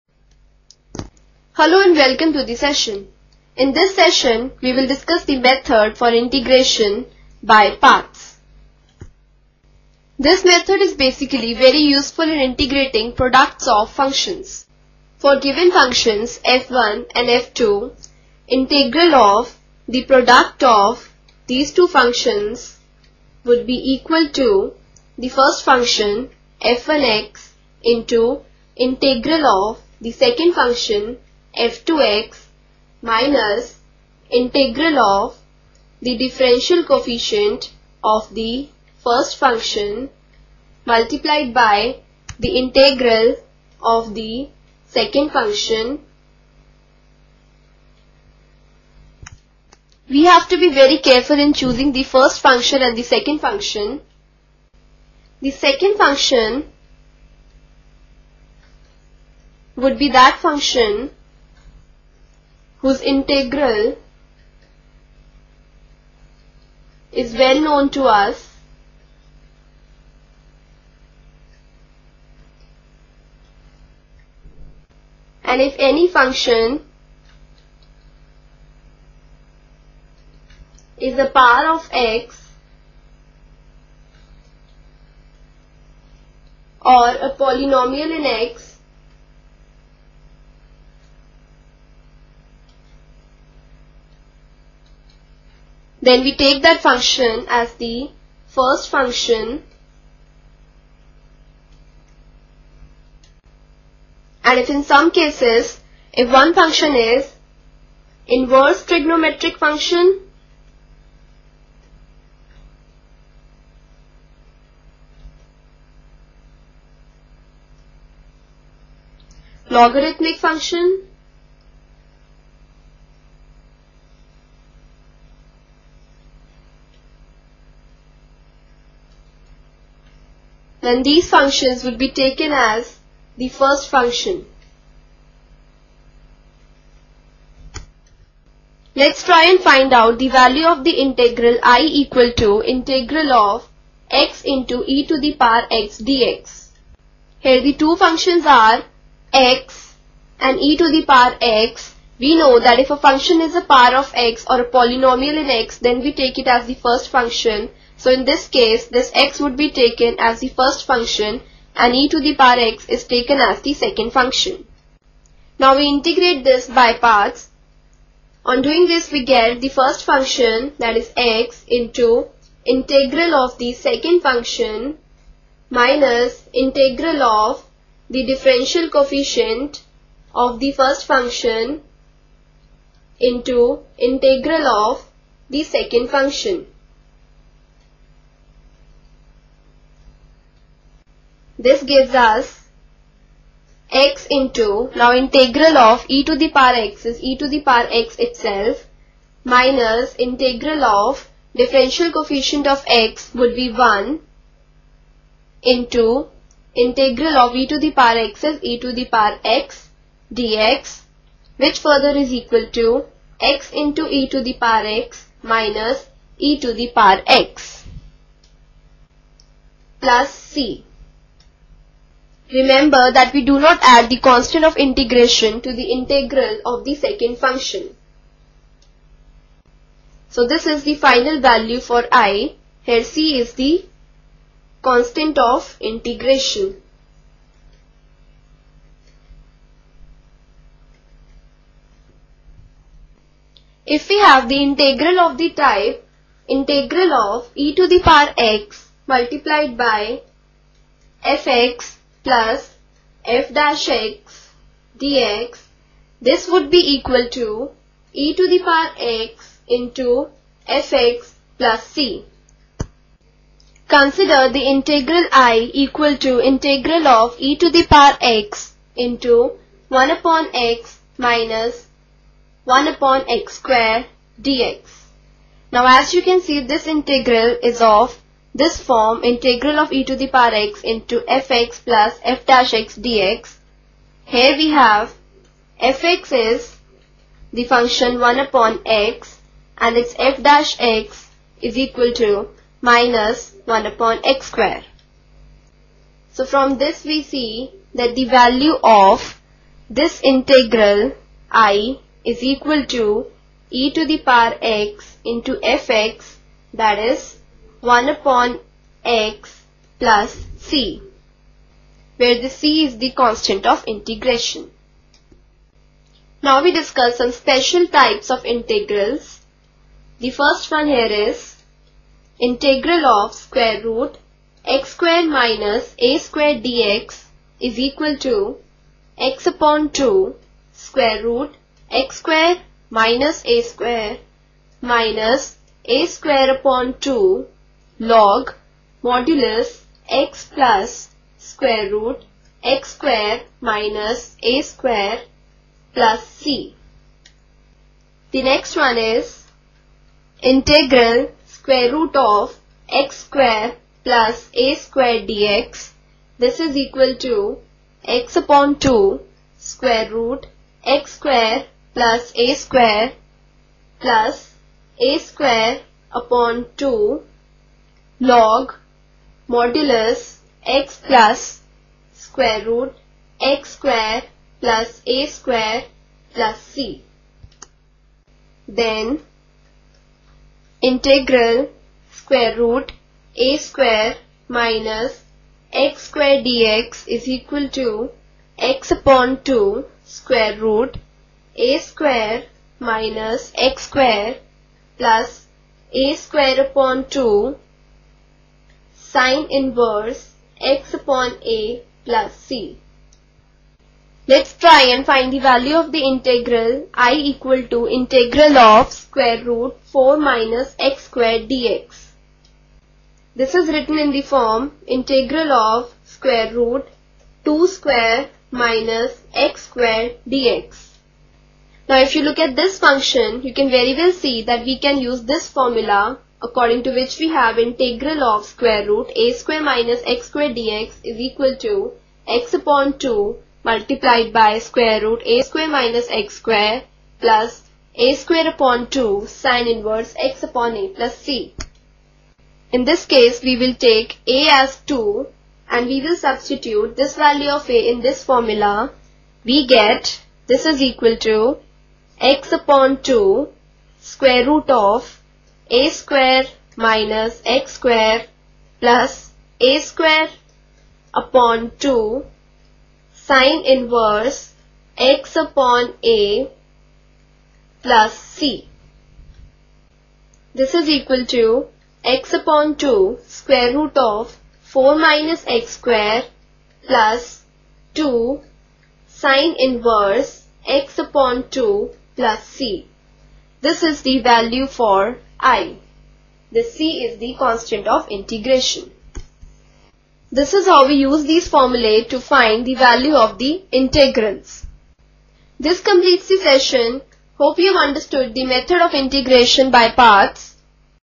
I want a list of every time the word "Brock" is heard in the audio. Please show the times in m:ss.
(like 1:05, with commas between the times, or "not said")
not said.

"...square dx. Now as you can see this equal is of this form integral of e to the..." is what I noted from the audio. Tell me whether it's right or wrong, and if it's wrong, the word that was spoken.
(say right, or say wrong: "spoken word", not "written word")
wrong: "integral", not "equal".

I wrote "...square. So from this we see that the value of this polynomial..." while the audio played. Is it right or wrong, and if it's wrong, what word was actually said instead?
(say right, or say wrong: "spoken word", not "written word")
wrong: "integral", not "polynomial".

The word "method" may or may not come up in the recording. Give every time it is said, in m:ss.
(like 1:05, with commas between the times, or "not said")
0:05, 0:10, 8:18.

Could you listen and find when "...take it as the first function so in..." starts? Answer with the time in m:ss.
2:36.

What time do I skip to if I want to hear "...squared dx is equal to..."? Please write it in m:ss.
5:26.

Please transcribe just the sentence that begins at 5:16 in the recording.
Now we discuss some special types of integrals.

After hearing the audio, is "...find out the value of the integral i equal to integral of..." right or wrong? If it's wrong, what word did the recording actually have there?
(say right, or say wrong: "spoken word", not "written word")
right.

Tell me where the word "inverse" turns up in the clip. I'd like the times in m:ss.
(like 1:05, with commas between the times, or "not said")
1:48, 6:39, 7:19, 7:43, 7:59.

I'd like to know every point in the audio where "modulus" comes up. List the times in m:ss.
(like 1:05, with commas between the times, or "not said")
5:39, 6:09.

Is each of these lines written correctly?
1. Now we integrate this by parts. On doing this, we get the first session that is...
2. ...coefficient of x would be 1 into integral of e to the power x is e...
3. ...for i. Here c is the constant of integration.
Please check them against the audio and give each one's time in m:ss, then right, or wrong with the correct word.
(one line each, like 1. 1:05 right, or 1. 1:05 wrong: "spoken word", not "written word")
1. 2:45 wrong: "function", not "session"
2. 3:22 right
3. 3:51 right.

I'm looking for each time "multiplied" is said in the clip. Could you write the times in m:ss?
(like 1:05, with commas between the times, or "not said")
0:40, 4:09, 7:13.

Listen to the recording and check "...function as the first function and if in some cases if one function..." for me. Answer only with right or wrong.
right.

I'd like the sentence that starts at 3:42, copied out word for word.
Remember that we do not add the constant of integration to the integral of the second function.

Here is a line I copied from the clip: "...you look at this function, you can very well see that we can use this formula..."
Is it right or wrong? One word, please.
right.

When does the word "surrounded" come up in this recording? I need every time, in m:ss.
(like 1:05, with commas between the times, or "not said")
not said.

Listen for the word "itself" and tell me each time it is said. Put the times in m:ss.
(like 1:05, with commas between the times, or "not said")
3:18.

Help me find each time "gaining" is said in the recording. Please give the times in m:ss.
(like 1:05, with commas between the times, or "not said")
not said.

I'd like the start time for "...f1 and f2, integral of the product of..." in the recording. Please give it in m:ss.
0:16.